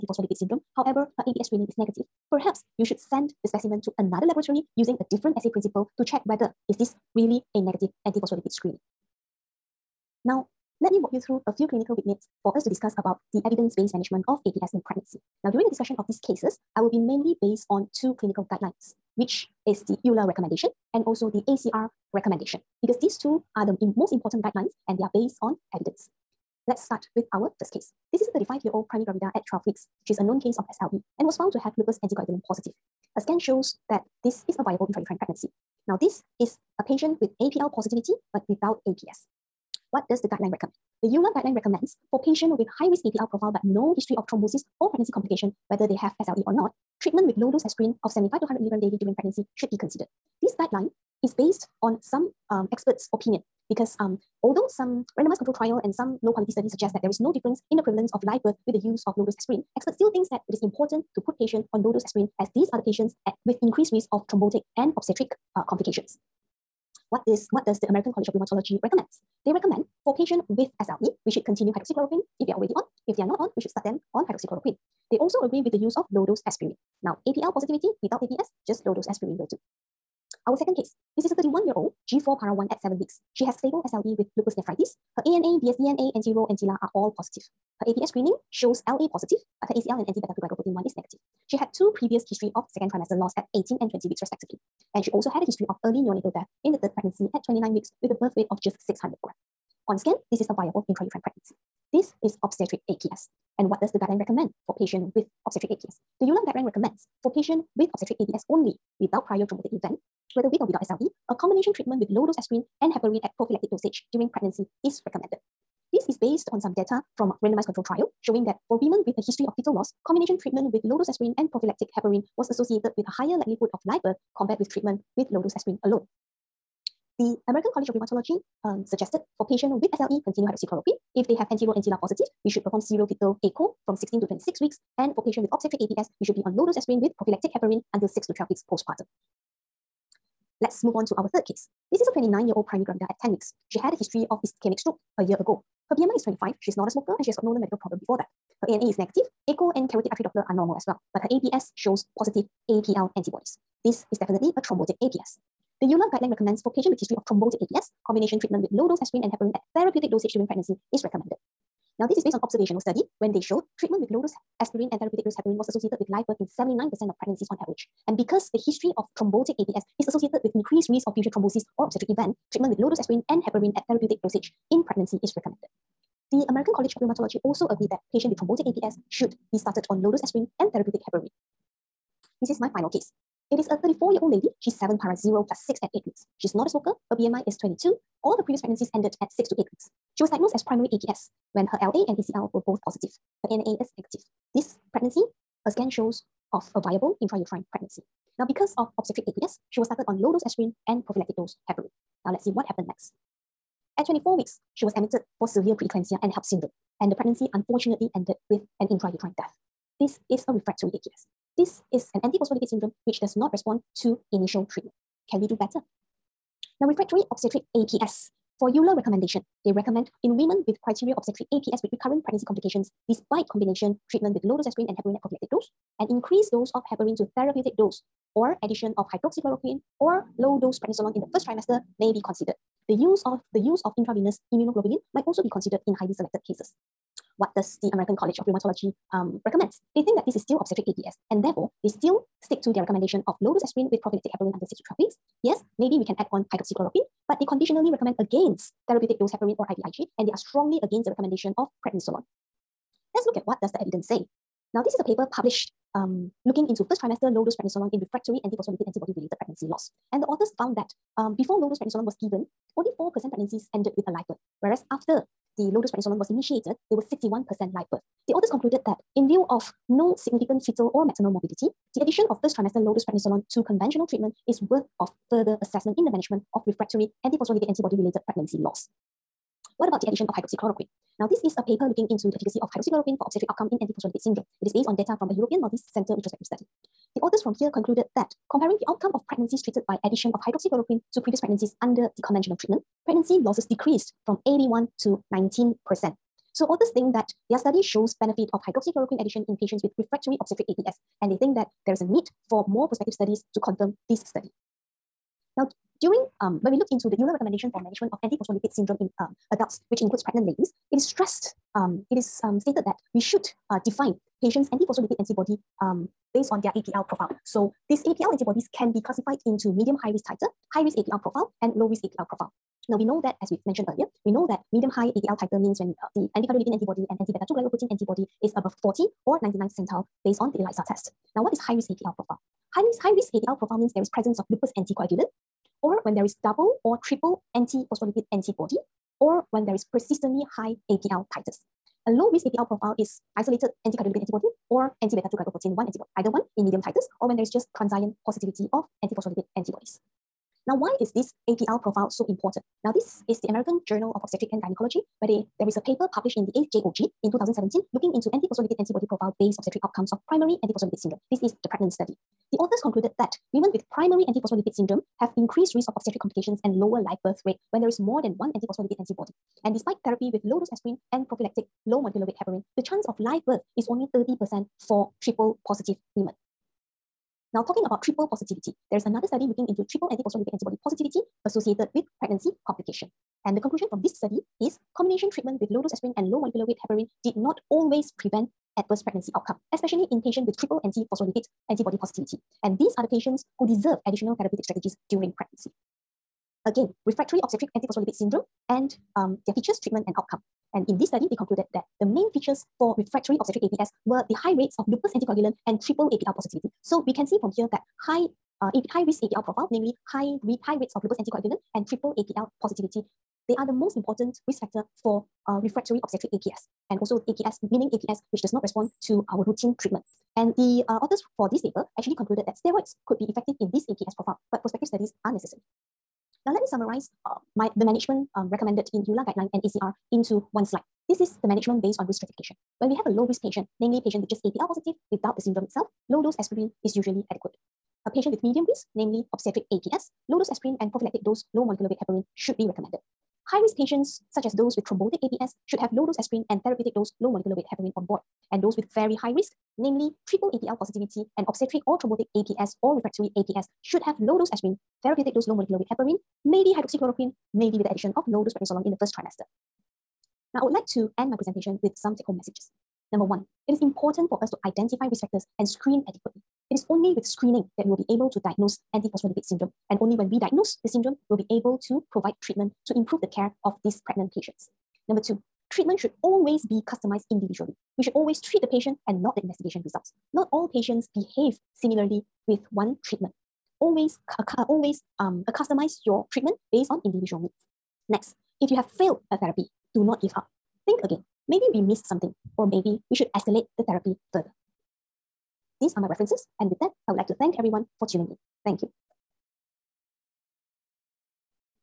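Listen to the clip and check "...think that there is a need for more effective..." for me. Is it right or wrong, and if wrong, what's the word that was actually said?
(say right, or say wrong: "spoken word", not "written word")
wrong: "prospective", not "effective".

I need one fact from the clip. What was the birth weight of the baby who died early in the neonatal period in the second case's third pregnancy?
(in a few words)
600 grams.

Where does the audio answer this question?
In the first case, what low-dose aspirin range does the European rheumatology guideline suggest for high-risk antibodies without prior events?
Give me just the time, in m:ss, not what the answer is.
0:48.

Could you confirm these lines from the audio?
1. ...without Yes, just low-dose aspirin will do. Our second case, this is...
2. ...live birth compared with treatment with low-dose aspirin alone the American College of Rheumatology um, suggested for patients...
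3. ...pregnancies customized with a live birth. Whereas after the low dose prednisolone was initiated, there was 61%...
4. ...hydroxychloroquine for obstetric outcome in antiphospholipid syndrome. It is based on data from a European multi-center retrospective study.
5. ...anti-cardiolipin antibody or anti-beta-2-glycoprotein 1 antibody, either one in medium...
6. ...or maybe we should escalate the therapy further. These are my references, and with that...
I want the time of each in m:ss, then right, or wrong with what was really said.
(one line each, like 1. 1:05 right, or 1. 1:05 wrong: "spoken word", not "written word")
1. 1:18 wrong: "APS", not "Yes"
2. 2:03 right
3. 4:23 wrong: "ended", not "customized"
4. 4:42 right
5. 5:43 right
6. 8:12 right.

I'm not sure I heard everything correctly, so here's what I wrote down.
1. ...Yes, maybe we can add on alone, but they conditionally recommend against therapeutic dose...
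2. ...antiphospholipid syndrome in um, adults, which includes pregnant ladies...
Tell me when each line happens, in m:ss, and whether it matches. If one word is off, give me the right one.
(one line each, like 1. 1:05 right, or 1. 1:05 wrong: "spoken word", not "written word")
1. 4:05 wrong: "hydroxychloroquine", not "alone"
2. 5:08 right.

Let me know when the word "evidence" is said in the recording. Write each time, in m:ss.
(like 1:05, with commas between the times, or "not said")
0:13, 0:25, 4:13.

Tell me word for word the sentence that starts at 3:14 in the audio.
This pregnancy, a scan shows of a viable intrauterine pregnancy.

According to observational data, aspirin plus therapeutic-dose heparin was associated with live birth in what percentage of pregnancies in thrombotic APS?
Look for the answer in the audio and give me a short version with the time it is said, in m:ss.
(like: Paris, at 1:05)
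79%, at 2:46.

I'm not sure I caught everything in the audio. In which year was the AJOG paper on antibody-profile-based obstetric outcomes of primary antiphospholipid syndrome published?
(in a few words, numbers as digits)
2017.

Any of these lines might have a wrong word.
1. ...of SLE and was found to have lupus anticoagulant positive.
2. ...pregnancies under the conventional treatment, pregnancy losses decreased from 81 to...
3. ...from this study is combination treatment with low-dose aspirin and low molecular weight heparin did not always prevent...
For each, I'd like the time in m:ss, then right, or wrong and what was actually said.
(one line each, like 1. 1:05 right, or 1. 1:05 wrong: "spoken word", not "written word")
1. 0:30 right
2. 4:51 right
3. 6:23 right.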